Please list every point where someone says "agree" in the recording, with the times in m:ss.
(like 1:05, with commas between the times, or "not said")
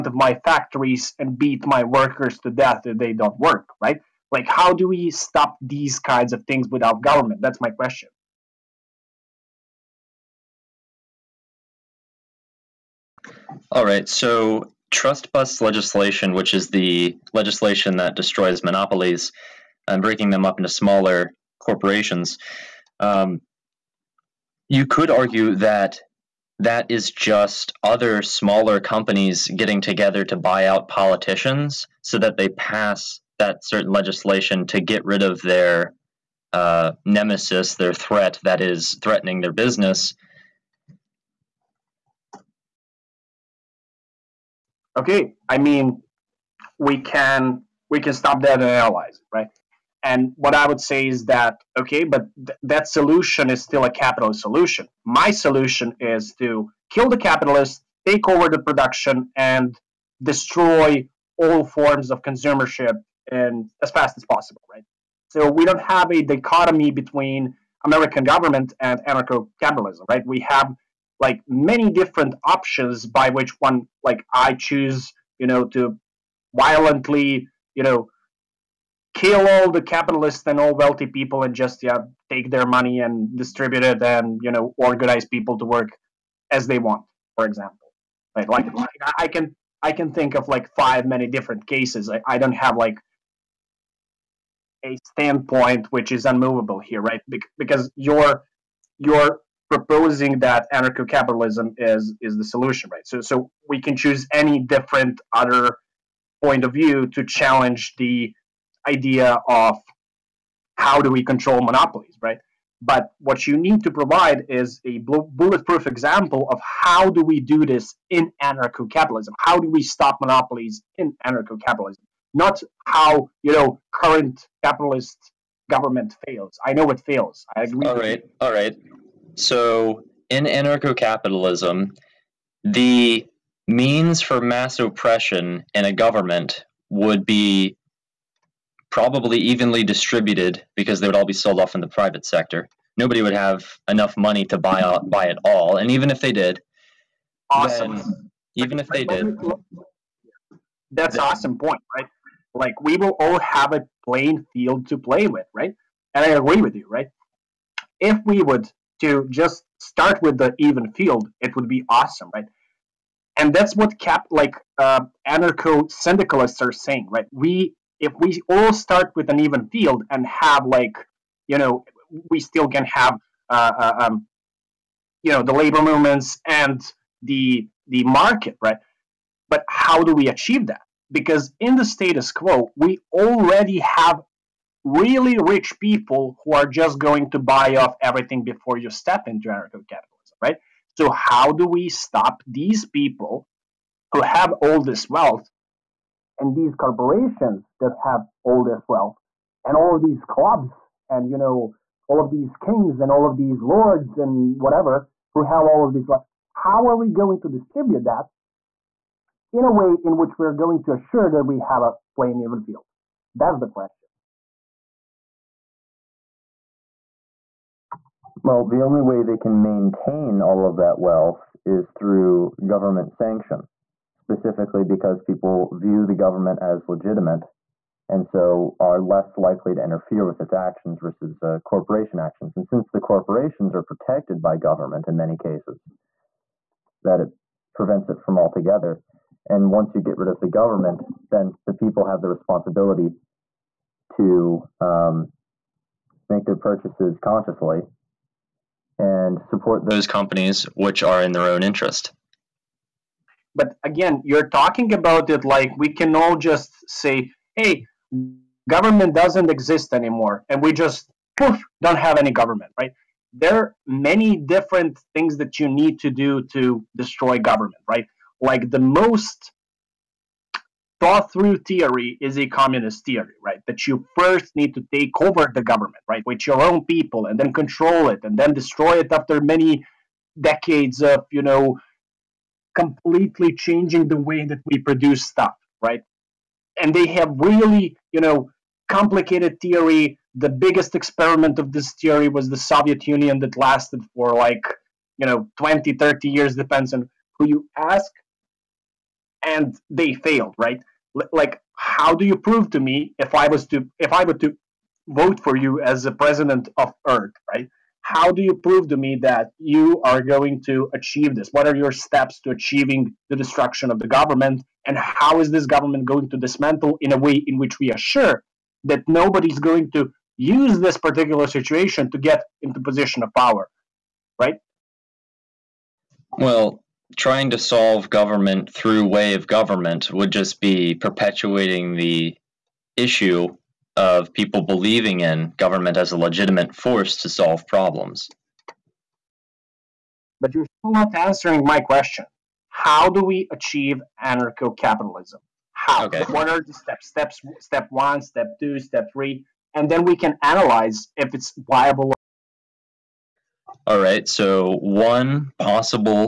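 2:07, 2:36.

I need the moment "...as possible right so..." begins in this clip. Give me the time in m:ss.
1:04.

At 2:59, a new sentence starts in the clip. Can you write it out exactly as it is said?
But how do we achieve that?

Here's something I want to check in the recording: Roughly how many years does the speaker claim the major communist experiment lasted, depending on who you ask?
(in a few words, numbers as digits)
20 to 30 years.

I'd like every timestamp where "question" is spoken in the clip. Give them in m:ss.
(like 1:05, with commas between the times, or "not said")
0:07, 3:33, 5:41.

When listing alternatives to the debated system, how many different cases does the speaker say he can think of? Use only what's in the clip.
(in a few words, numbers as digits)
5.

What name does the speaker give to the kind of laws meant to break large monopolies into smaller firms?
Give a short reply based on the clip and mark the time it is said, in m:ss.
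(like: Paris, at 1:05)
Trust bust legislation, at 0:14.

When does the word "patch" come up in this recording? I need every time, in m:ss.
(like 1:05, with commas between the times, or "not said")
not said.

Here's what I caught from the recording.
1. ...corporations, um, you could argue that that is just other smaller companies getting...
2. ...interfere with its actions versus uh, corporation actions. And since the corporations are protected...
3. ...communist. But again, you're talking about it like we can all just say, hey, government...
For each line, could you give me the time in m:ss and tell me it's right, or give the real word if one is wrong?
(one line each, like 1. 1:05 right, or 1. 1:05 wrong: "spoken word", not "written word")
1. 0:21 right
2. 3:49 right
3. 4:11 wrong: "interest", not "communist".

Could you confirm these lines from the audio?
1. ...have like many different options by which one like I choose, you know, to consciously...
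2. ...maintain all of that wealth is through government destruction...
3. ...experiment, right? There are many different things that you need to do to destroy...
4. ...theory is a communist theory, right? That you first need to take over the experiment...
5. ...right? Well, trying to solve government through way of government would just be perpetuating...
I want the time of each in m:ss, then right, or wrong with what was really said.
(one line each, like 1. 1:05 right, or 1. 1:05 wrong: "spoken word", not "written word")
1. 1:10 wrong: "violently", not "consciously"
2. 3:39 wrong: "sanction", not "destruction"
3. 4:22 wrong: "government", not "experiment"
4. 4:31 wrong: "government", not "experiment"
5. 5:24 right.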